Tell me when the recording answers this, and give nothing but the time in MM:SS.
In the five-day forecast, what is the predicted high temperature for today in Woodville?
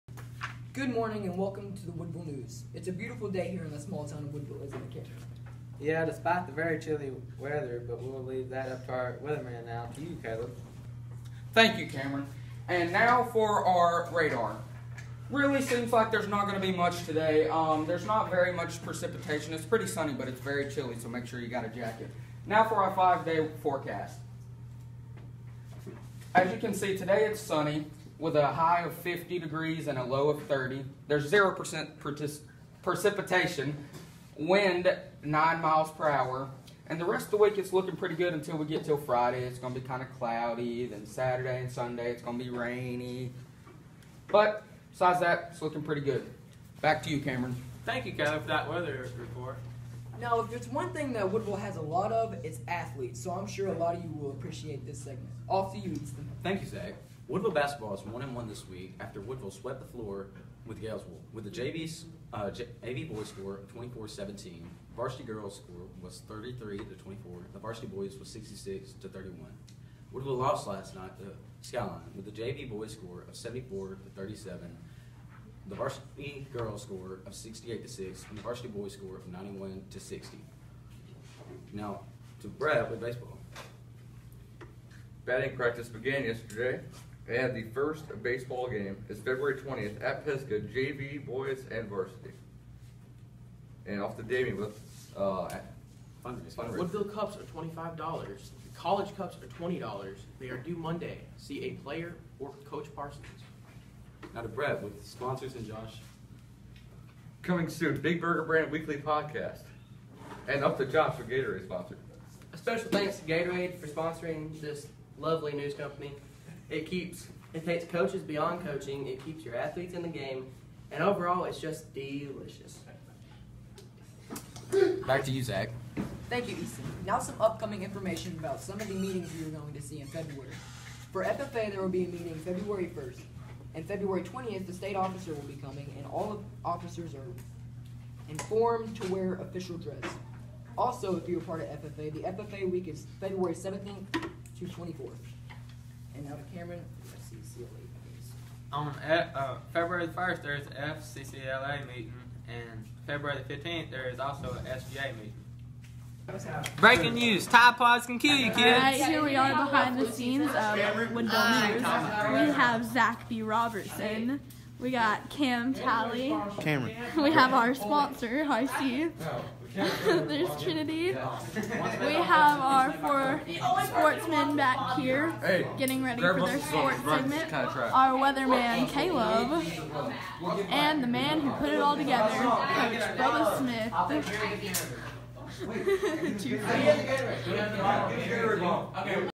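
00:28.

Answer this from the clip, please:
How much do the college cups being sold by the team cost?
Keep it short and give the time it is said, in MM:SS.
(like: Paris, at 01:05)
$20, at 01:39.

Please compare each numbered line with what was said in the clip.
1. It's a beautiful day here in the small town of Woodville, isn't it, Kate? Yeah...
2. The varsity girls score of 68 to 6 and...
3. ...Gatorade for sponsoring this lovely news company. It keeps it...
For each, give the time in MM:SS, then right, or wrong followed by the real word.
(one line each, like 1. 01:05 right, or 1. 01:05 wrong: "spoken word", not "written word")
1. 00:02 right
2. 01:15 right
3. 01:53 right.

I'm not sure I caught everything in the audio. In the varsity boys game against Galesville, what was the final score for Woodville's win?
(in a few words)
66 to 31.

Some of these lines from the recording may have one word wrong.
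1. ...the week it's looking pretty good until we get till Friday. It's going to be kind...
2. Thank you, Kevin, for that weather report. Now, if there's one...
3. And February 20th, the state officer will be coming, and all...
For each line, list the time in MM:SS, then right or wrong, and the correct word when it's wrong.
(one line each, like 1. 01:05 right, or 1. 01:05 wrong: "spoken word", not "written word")
1. 00:37 right
2. 00:47 right
3. 02:13 right.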